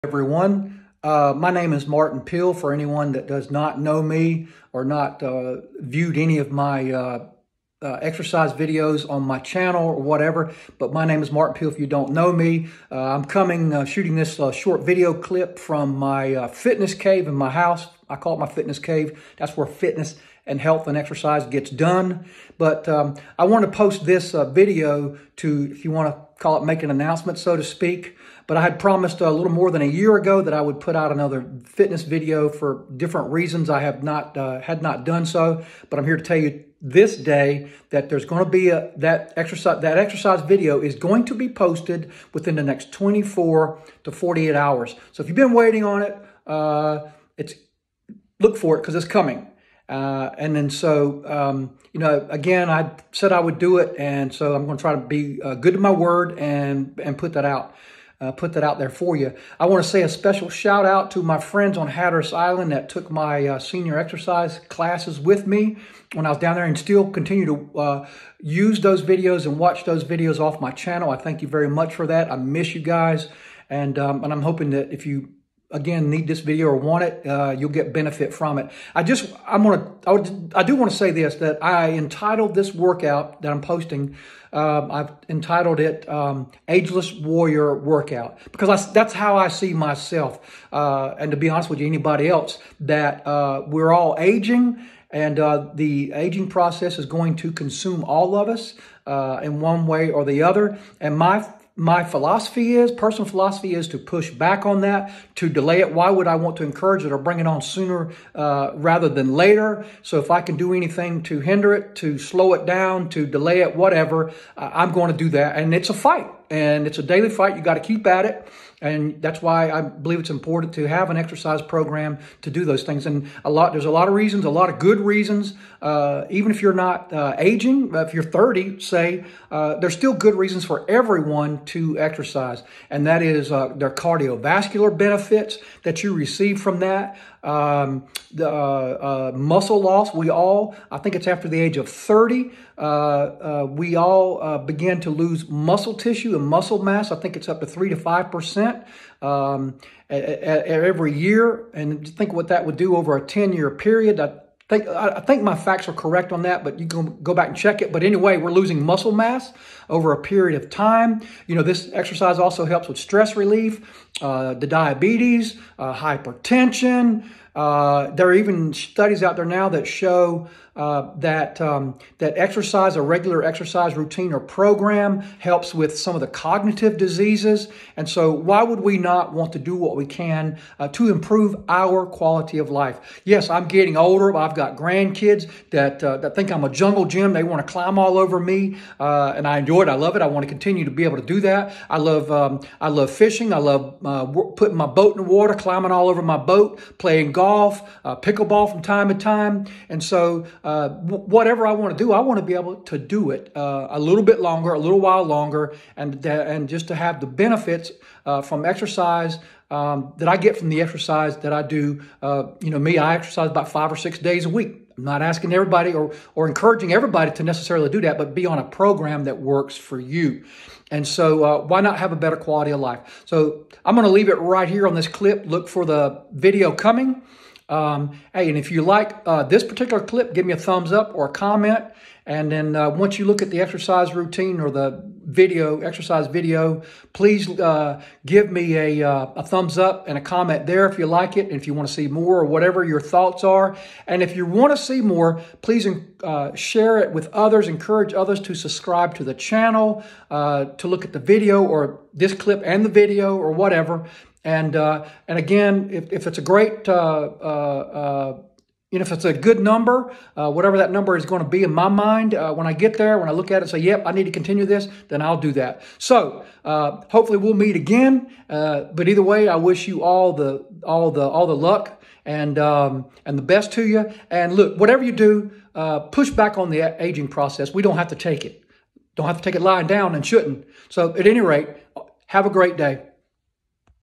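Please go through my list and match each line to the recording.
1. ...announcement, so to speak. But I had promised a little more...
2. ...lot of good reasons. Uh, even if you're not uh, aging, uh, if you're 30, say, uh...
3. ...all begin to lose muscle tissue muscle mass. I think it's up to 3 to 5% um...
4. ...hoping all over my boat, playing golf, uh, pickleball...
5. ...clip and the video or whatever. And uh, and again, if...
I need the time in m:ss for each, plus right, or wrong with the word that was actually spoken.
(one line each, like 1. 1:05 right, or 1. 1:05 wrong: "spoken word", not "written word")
1. 0:26 right
2. 2:04 right
3. 2:23 right
4. 3:15 wrong: "climbing", not "hoping"
5. 4:12 right.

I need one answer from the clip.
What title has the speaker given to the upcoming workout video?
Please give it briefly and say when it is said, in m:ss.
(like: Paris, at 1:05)
Ageless Warrior Workout, at 1:26.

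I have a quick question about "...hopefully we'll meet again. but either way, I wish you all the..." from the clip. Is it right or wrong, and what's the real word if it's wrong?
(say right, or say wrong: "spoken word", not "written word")
right.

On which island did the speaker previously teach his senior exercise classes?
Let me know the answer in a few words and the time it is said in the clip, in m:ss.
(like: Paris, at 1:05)
Hatteras Island, at 1:01.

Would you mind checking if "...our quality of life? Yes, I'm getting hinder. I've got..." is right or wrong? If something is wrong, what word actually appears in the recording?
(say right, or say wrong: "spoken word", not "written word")
wrong: "older", not "hinder".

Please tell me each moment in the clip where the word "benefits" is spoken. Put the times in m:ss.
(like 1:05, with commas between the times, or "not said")
1:17, 2:14, 3:27.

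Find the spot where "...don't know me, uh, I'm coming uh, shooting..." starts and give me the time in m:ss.
0:11.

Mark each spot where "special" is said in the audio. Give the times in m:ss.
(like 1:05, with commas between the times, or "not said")
1:00.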